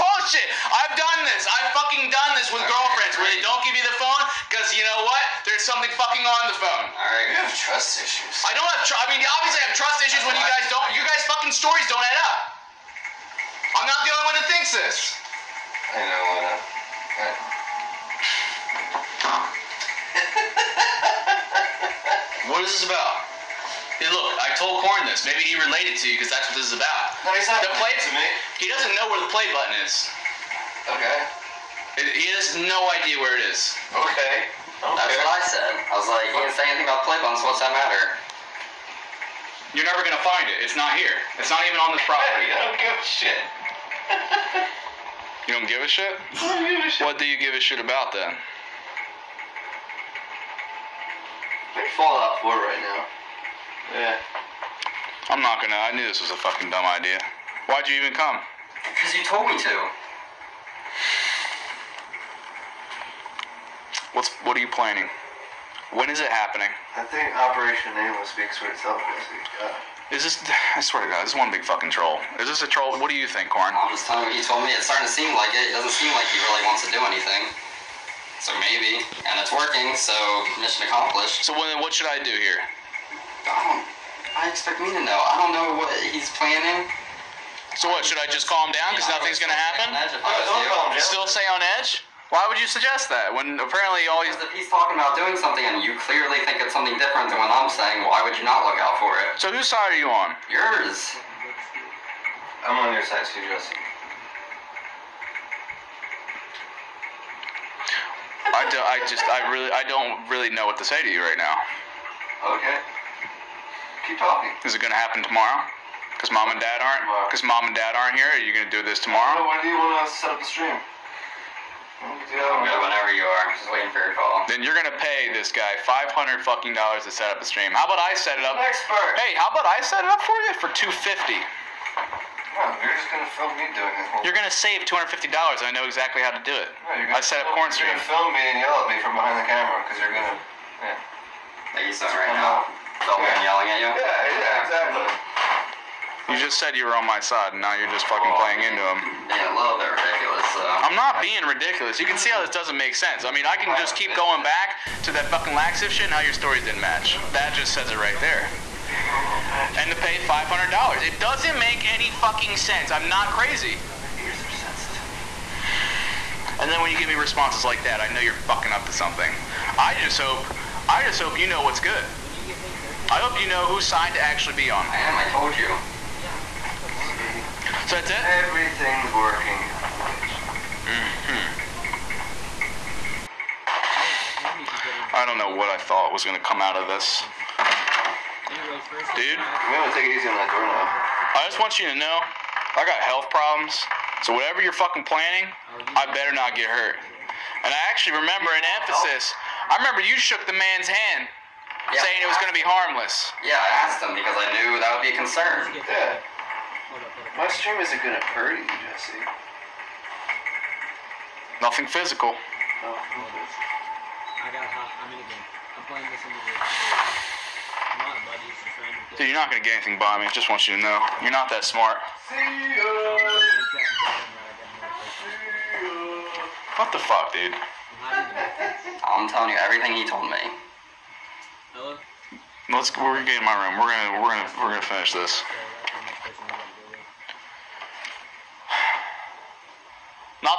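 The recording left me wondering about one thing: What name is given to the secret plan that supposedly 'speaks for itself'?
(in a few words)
Operation Nameless.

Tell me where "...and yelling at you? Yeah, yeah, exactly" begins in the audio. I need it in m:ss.
2:23.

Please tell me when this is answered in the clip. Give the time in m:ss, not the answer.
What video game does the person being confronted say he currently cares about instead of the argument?
0:51.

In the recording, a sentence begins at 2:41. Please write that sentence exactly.
It doesn't make any fucking sense.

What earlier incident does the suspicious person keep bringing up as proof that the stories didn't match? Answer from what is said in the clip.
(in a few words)
Laxative.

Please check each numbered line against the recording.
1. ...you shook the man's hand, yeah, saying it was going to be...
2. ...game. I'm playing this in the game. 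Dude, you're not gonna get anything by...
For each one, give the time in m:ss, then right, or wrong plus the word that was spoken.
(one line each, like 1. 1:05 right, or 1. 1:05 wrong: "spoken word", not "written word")
1. 3:20 right
2. 3:35 right.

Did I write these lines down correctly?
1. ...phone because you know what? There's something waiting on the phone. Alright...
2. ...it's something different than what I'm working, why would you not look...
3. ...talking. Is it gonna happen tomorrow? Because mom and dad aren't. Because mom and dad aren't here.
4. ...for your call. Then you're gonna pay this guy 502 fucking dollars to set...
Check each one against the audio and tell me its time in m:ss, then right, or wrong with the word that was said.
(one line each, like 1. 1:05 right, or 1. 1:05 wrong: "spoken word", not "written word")
1. 0:03 wrong: "fucking", not "waiting"
2. 1:36 wrong: "saying", not "working"
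3. 1:54 right
4. 2:03 wrong: "500", not "502".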